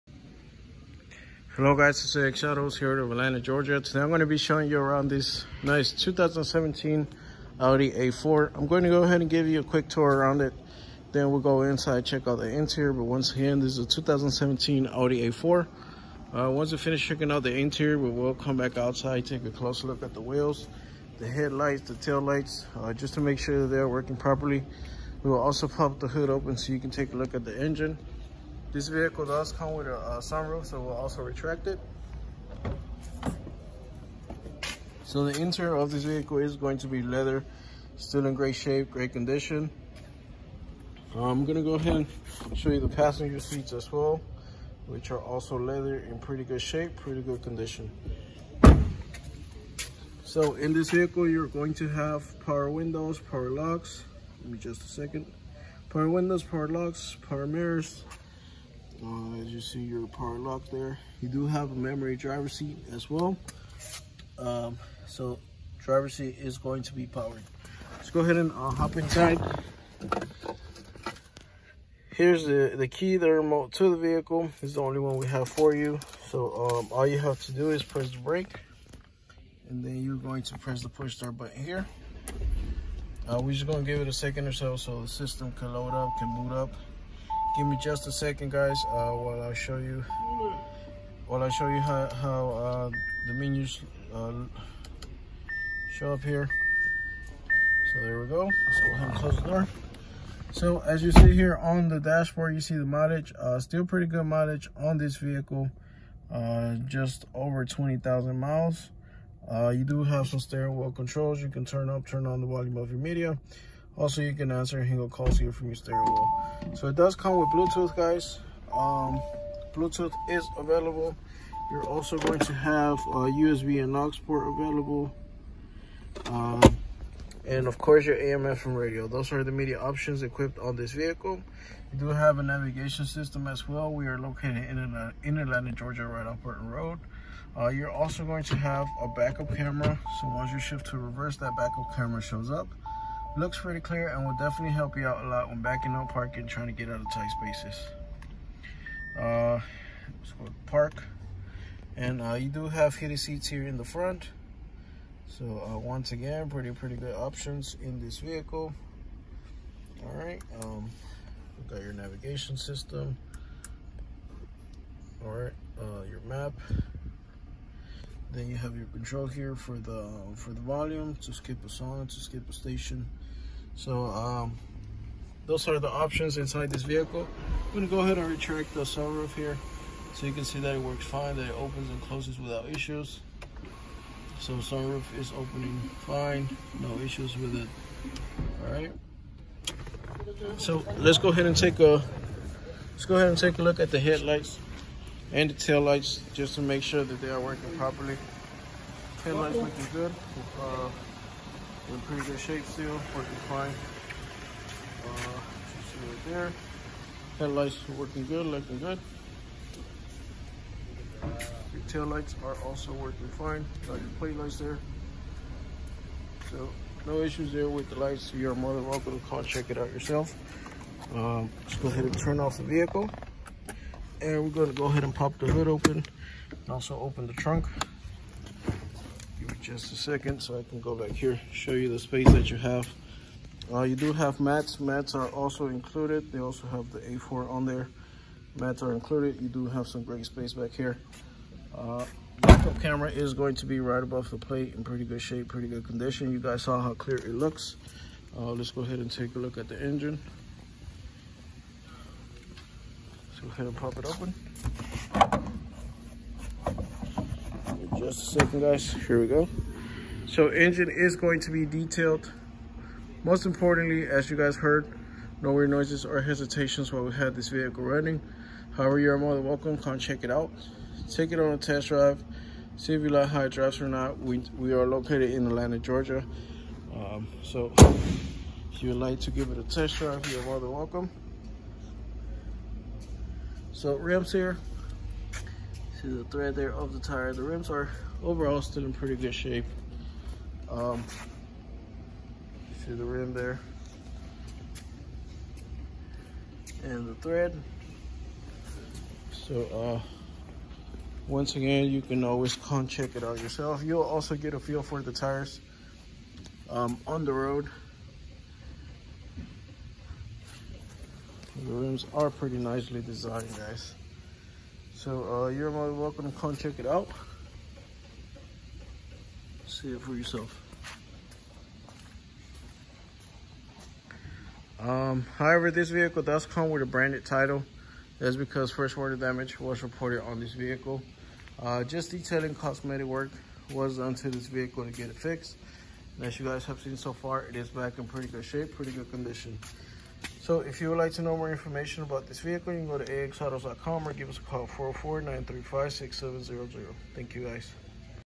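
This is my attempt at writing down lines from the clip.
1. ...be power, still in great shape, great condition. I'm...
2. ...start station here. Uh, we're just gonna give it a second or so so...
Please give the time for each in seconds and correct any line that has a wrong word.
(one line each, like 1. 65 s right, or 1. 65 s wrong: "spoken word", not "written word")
1. 36 s wrong: "leather", not "power"
2. 81 s wrong: "button", not "station".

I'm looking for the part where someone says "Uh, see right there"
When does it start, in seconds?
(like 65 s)
205 s.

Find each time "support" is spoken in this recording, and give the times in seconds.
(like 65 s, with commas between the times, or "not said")
not said.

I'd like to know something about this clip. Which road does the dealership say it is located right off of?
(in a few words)
Burton Road.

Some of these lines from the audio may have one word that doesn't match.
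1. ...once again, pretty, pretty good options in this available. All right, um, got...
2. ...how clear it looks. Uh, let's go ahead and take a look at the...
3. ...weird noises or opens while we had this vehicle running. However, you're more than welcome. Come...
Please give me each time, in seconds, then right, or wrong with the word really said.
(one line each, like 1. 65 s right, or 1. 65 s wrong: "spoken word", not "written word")
1. 155 s wrong: "vehicle", not "available"
2. 246 s right
3. 265 s wrong: "hesitations", not "opens".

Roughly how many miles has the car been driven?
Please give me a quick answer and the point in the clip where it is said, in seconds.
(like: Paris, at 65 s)
just over 20,000 miles, at 106 s.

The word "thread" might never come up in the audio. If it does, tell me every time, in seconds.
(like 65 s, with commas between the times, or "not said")
286 s, 297 s.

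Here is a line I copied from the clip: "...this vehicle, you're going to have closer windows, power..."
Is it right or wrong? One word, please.
wrong.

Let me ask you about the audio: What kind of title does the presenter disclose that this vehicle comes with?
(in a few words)
branded title.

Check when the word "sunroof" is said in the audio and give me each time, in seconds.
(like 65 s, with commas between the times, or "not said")
30 s, 178 s, 184 s.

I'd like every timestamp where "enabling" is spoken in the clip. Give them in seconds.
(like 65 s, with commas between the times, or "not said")
not said.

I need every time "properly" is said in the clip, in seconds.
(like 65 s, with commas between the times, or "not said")
24 s, 197 s.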